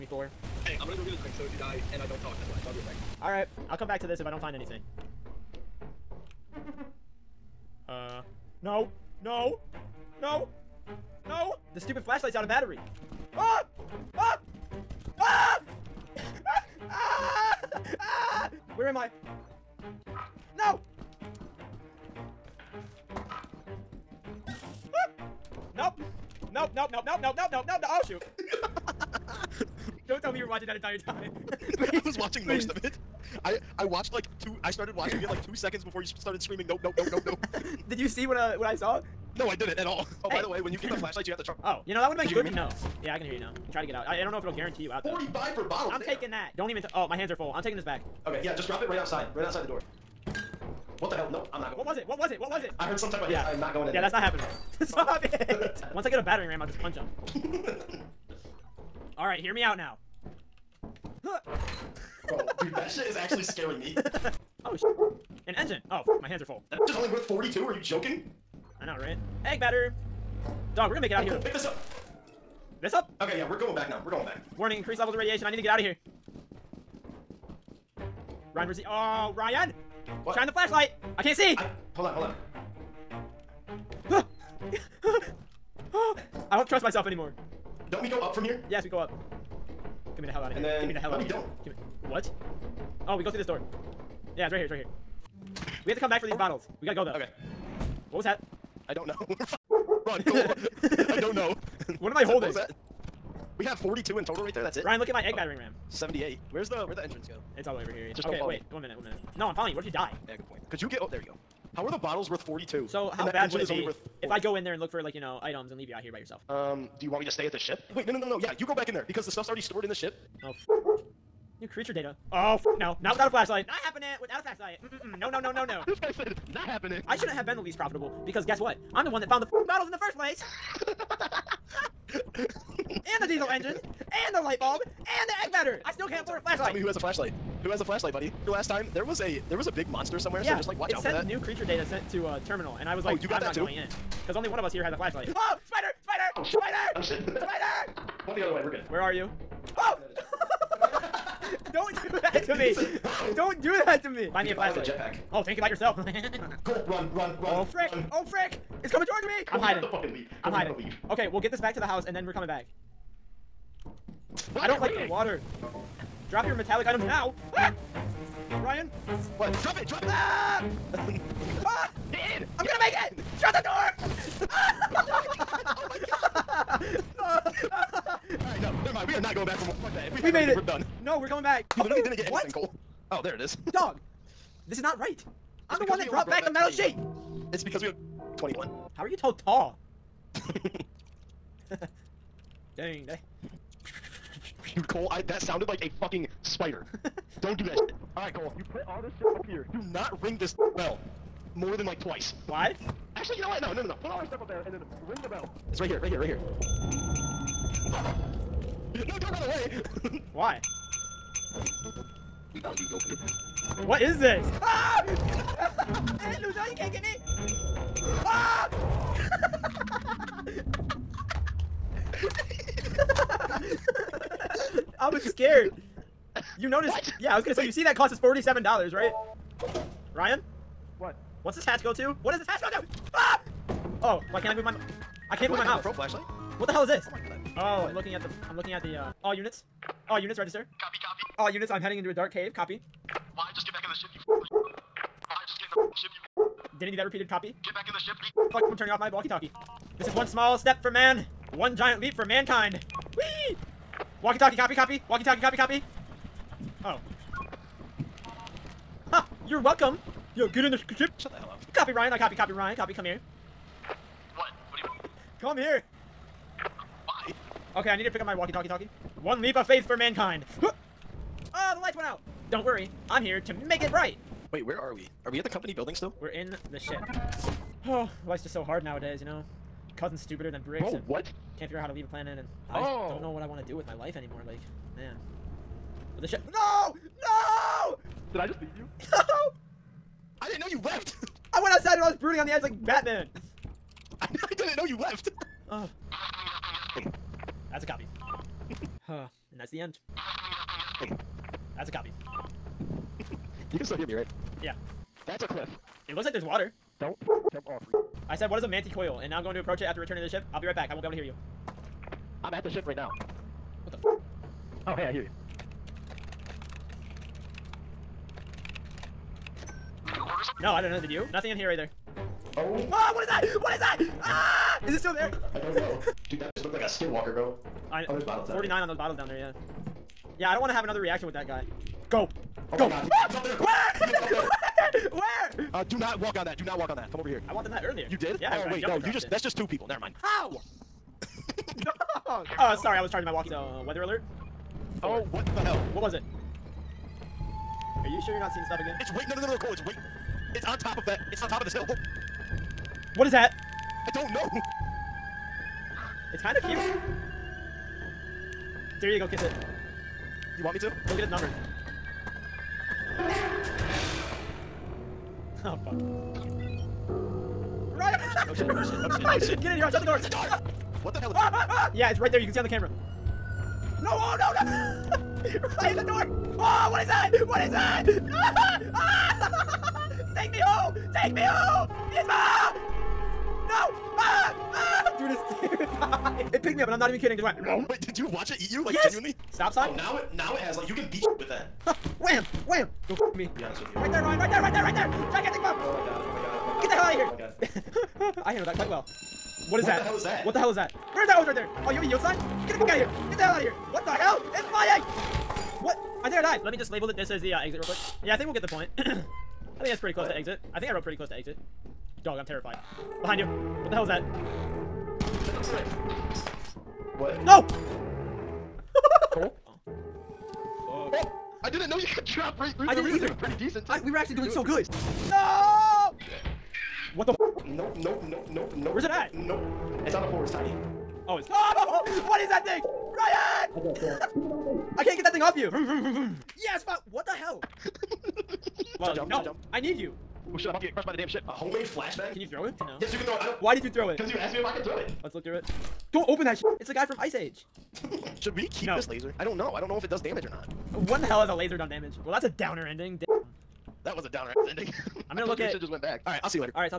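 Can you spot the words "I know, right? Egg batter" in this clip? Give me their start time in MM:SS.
01:08.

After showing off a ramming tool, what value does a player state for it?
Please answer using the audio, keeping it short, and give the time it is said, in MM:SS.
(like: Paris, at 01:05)
78, at 01:45.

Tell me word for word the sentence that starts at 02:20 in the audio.
so just like watch it out for that.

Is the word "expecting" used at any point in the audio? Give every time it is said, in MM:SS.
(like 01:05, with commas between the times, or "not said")
not said.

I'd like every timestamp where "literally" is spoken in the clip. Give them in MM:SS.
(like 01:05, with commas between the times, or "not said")
03:01.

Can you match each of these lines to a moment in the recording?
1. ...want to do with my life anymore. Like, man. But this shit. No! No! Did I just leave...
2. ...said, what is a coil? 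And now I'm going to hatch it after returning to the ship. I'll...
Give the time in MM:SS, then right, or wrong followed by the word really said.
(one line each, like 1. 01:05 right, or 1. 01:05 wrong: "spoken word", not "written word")
1. 04:43 right
2. 05:08 wrong: "approach", not "hatch".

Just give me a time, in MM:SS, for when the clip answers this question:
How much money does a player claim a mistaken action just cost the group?
03:48.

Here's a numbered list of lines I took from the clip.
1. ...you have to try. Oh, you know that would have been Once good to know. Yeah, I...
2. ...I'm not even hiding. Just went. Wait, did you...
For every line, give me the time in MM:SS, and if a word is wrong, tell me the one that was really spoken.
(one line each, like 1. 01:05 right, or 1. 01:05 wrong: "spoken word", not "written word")
1. 00:41 wrong: "Did", not "Once"
2. 06:26 wrong: "kidding", not "hiding".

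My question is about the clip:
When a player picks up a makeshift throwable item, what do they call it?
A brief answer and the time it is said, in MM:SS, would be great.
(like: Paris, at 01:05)
Homemade flashbang, at 07:21.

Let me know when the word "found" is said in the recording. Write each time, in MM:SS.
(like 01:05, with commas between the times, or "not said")
02:09.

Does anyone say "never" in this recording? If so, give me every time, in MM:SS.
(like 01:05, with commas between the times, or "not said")
02:58, 05:39.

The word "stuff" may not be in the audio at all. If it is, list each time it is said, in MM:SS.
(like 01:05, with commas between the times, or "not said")
01:59, 03:24, 05:48.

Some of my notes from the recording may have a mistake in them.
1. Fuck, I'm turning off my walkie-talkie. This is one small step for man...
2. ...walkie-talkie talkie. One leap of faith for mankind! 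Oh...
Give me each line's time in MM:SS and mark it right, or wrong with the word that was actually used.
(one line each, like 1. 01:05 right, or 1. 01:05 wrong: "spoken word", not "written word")
1. 04:08 right
2. 04:28 right.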